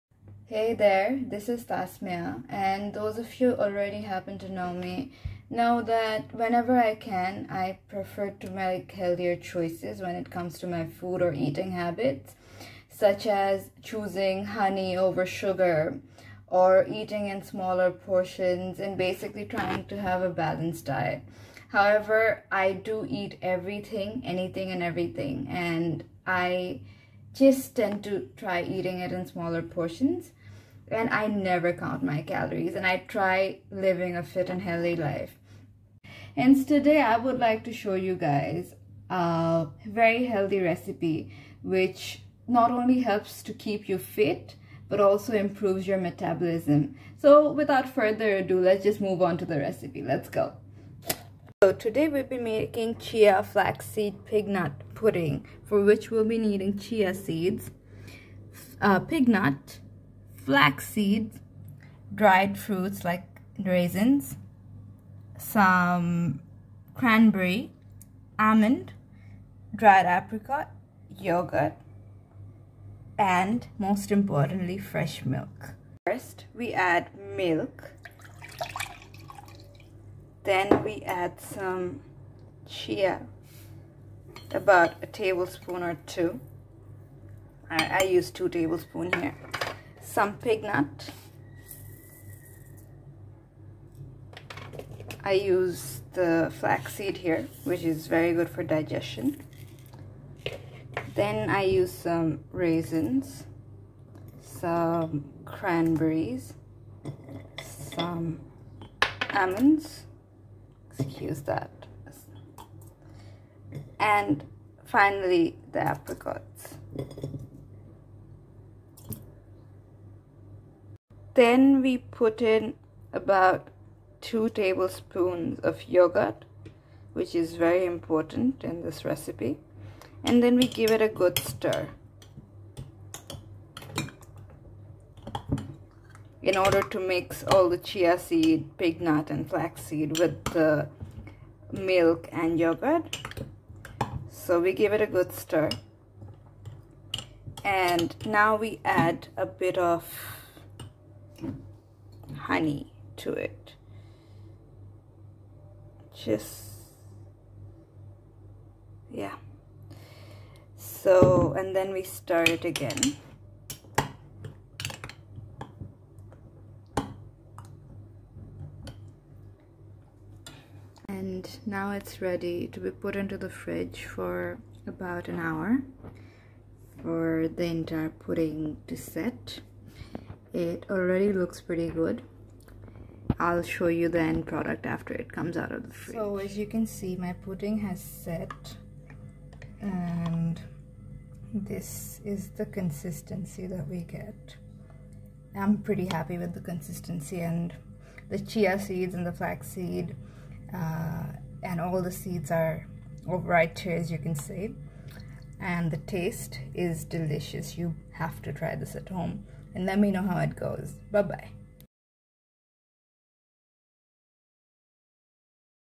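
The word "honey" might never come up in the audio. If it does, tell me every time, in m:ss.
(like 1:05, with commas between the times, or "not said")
0:14, 2:32.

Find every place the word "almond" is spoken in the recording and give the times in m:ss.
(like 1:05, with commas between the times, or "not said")
1:08, 1:49.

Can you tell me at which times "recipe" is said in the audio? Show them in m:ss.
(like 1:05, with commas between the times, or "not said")
0:40, 0:49, 2:09.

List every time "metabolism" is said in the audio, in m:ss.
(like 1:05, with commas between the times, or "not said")
0:45.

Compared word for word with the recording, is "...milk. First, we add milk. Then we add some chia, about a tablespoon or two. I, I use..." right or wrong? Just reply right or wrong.
right.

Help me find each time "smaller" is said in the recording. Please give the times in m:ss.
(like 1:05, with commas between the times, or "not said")
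0:17, 0:29.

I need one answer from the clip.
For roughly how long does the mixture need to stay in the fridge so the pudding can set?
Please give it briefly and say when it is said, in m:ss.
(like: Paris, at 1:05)
about an hour, at 2:54.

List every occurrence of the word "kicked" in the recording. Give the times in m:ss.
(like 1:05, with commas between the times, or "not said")
not said.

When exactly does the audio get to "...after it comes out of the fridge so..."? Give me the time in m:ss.
3:04.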